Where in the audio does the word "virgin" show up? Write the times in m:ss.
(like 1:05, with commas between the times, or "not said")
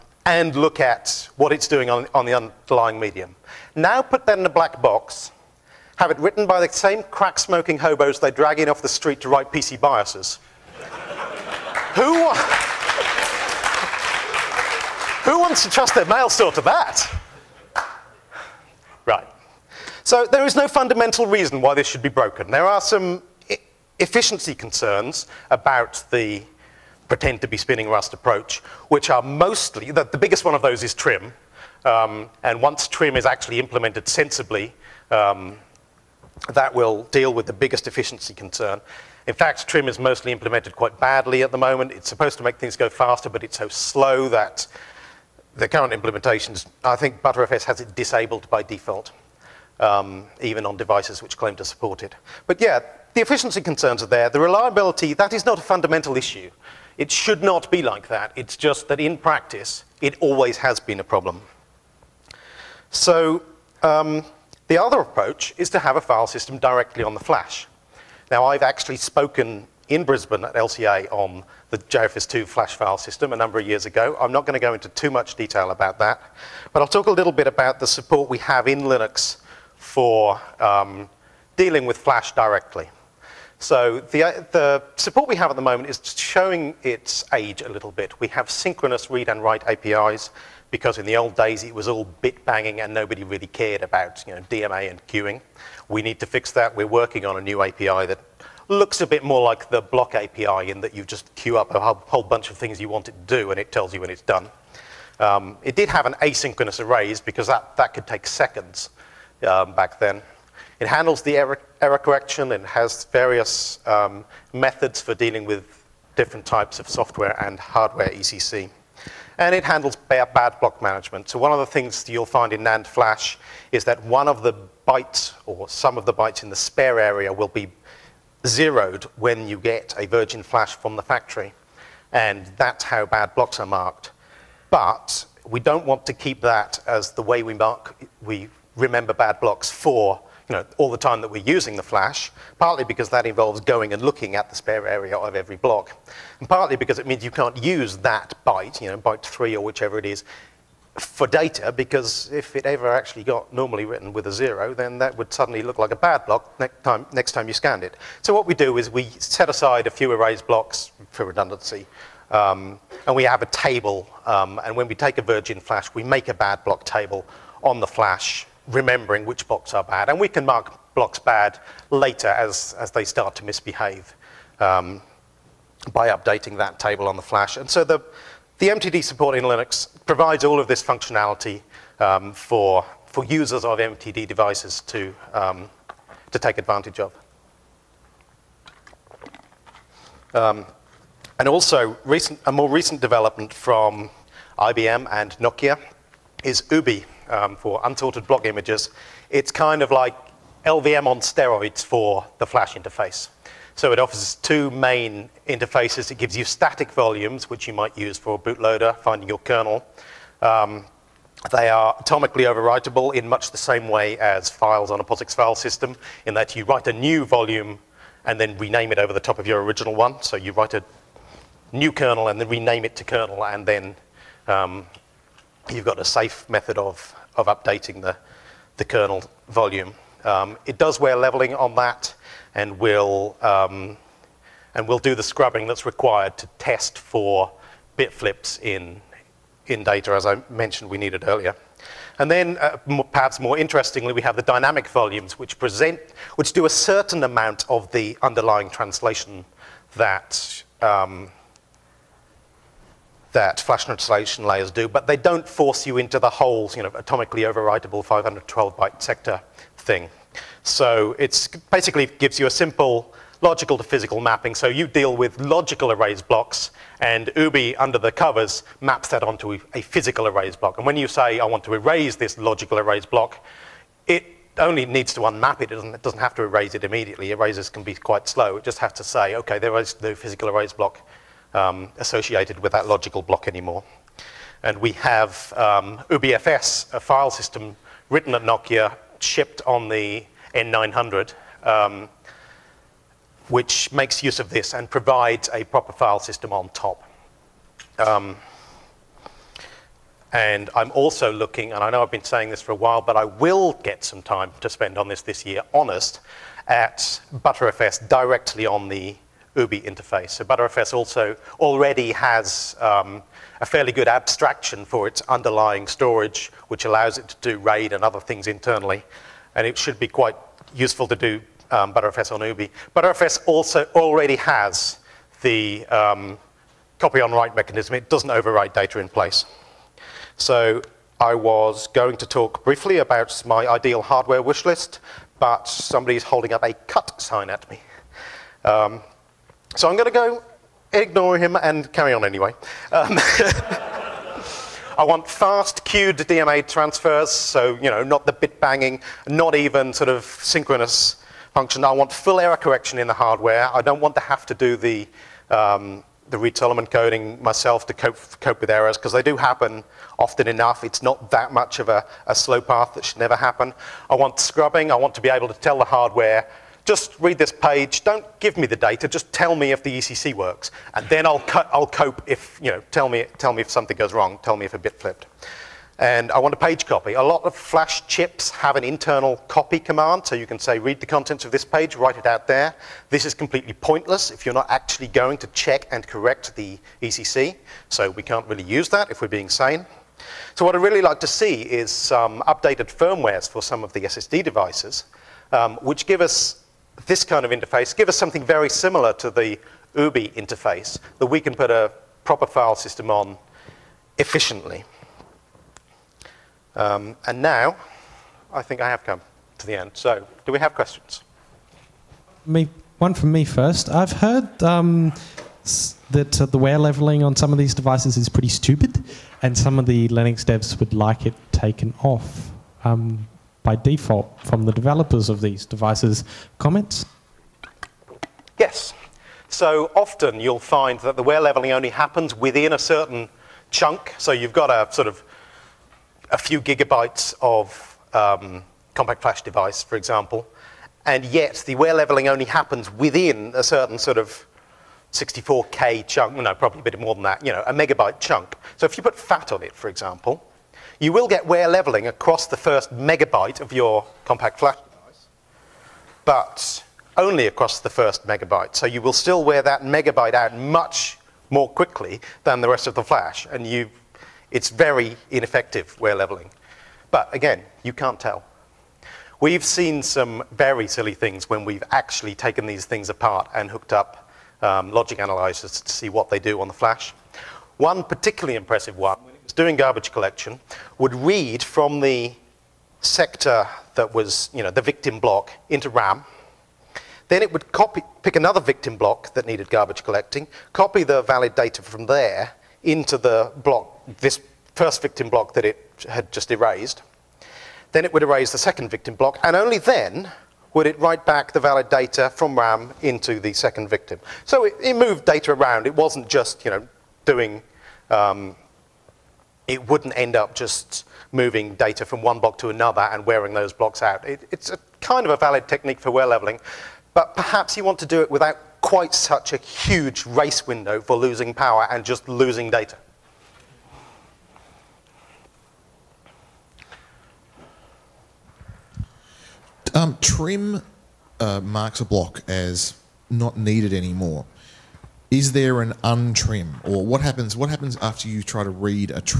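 2:10, 2:45.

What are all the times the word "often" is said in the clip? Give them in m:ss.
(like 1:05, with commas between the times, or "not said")
6:00, 7:09.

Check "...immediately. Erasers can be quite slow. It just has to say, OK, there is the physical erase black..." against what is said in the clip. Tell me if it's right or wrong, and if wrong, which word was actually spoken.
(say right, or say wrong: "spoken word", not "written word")
wrong: "block", not "black".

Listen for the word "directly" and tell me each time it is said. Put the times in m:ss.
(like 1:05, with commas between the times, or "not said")
1:06, 1:22, 5:08.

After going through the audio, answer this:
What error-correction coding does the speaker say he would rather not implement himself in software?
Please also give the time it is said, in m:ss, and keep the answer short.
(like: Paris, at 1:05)
Reed-Solomon, at 5:56.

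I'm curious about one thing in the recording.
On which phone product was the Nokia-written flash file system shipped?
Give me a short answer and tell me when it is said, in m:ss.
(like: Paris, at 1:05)
N900, at 4:50.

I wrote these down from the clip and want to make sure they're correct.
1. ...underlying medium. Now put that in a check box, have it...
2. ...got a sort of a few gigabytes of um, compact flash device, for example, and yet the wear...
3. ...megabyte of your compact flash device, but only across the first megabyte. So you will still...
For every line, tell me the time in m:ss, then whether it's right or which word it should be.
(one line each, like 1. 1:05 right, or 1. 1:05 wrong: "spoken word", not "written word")
1. 0:02 wrong: "black", not "check"
2. 7:14 right
3. 7:32 right.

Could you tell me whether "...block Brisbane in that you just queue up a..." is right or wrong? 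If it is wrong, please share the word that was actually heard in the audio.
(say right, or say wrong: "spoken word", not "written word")
wrong: "API", not "Brisbane".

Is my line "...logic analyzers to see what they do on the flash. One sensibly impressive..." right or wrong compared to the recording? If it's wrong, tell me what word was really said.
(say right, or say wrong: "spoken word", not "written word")
wrong: "particularly", not "sensibly".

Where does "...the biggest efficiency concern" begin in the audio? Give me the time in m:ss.
0:37.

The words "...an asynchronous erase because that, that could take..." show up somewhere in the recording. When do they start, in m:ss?
1:46.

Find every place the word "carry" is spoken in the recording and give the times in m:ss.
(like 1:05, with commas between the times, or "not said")
5:41.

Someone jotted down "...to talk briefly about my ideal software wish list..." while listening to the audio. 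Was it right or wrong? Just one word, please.
wrong.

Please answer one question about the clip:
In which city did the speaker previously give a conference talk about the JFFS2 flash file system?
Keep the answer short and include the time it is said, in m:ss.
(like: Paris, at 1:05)
Brisbane, at 1:10.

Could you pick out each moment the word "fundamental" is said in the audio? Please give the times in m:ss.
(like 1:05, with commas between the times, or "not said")
0:20, 0:55.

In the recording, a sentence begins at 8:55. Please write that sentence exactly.
Is there an untrim, or what happens?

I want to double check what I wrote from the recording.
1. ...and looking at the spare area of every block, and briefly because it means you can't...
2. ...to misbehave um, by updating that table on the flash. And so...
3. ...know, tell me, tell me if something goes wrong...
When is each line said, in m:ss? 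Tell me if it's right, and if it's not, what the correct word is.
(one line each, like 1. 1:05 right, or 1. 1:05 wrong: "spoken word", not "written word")
1. 2:23 wrong: "partly", not "briefly"
2. 2:53 right
3. 6:12 right.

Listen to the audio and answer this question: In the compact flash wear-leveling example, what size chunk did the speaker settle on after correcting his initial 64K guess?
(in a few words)
a megabyte.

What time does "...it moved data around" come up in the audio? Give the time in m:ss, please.
8:24.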